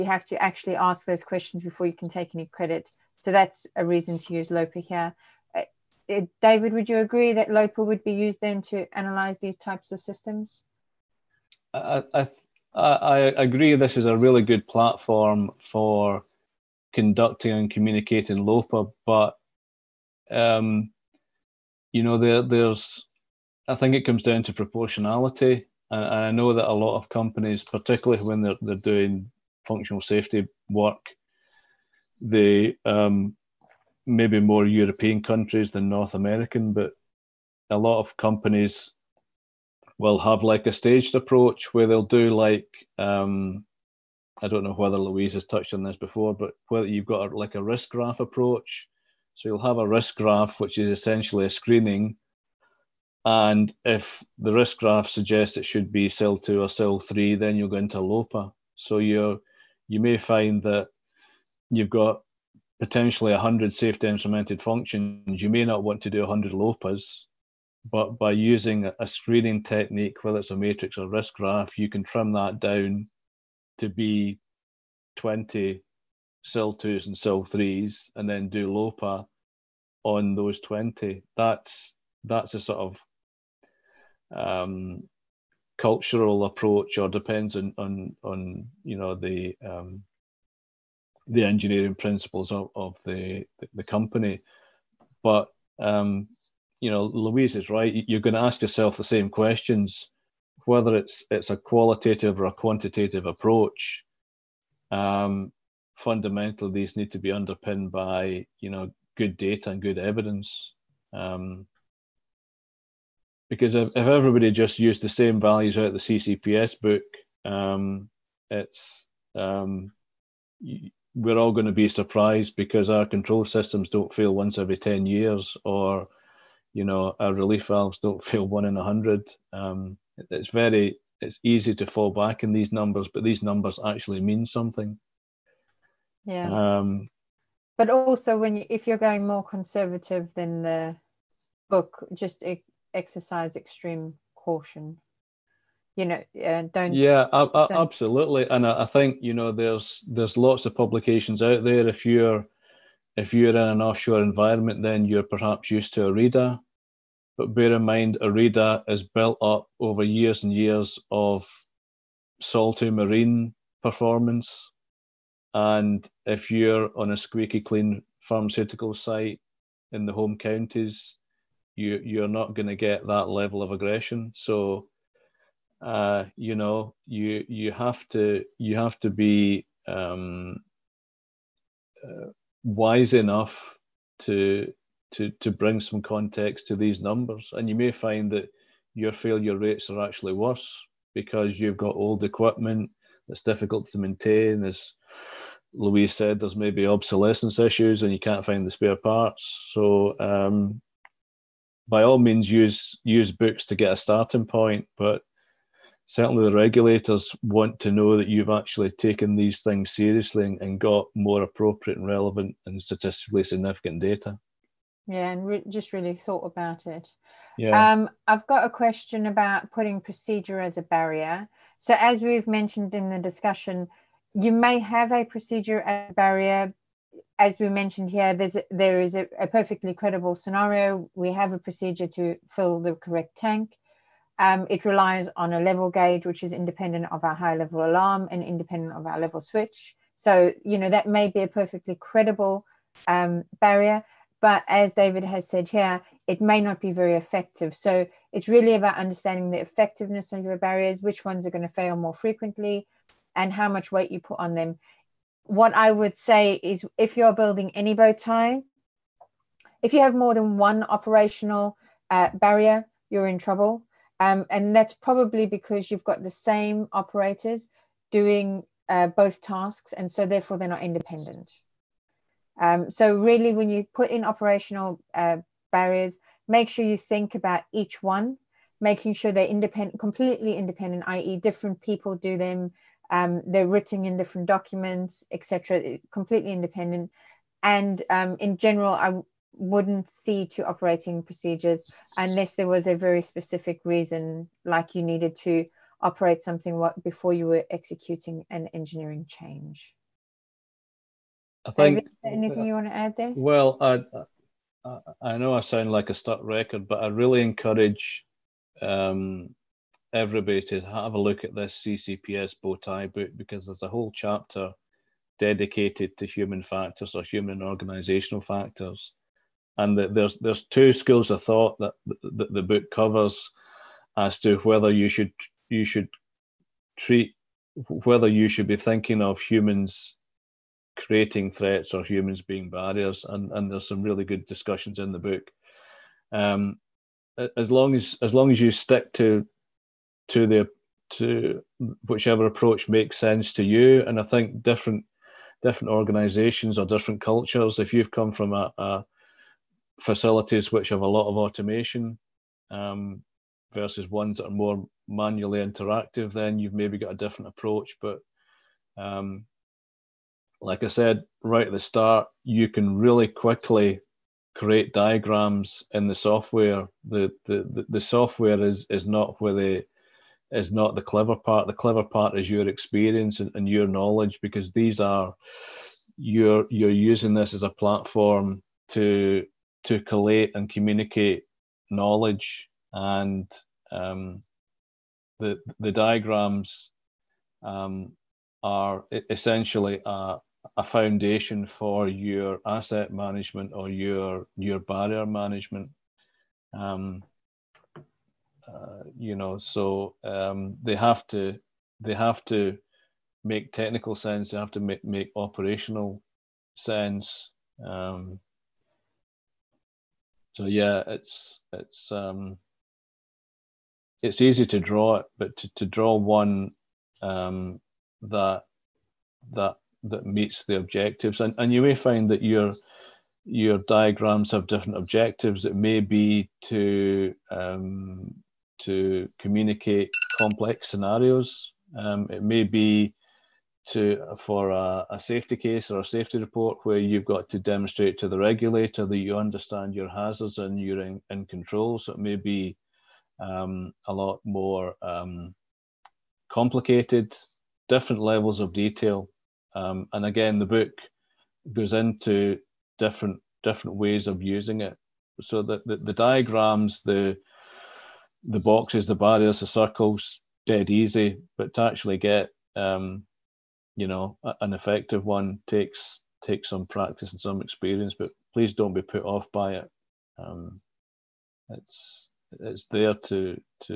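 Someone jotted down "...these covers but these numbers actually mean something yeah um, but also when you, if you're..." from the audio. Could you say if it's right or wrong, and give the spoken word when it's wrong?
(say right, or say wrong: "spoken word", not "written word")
wrong: "numbers", not "covers".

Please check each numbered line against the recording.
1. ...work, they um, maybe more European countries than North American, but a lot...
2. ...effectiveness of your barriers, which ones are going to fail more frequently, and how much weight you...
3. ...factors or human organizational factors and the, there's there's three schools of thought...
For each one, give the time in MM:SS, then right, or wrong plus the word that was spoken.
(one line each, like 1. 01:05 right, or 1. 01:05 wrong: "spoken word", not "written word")
1. 00:30 right
2. 04:09 right
3. 05:16 wrong: "two", not "three".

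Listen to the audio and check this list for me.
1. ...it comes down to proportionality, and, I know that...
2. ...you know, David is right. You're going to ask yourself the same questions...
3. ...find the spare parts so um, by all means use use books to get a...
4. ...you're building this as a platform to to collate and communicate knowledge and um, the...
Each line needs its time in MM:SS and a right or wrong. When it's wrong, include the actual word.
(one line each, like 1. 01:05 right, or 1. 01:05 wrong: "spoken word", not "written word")
1. 00:23 right
2. 01:36 wrong: "Louise", not "David"
3. 03:18 right
4. 06:16 wrong: "using", not "building".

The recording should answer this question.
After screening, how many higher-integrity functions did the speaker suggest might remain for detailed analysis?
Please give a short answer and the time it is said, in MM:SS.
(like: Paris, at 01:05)
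20, at 01:15.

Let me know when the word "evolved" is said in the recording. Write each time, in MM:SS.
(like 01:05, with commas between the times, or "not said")
not said.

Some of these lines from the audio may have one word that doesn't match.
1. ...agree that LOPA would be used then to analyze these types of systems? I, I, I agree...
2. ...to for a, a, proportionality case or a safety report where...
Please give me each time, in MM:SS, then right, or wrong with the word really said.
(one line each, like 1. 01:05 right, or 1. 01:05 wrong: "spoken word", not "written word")
1. 00:06 right
2. 07:13 wrong: "safety", not "proportionality".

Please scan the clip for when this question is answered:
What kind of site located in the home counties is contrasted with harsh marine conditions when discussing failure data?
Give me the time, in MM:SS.
02:48.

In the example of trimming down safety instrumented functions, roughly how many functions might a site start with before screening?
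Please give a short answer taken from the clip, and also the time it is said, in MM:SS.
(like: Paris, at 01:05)
100, at 01:03.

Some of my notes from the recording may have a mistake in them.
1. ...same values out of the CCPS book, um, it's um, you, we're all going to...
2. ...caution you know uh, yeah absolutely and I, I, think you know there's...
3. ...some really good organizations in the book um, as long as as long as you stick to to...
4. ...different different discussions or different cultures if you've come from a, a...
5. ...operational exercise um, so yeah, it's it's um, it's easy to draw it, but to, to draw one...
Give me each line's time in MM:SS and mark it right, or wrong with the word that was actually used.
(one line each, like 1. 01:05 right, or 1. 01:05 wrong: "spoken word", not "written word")
1. 01:55 right
2. 02:24 right
3. 05:33 wrong: "discussions", not "organizations"
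4. 05:44 wrong: "organizations", not "discussions"
5. 06:45 wrong: "sense", not "exercise".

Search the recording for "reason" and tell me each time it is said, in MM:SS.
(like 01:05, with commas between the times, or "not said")
00:03, 04:53.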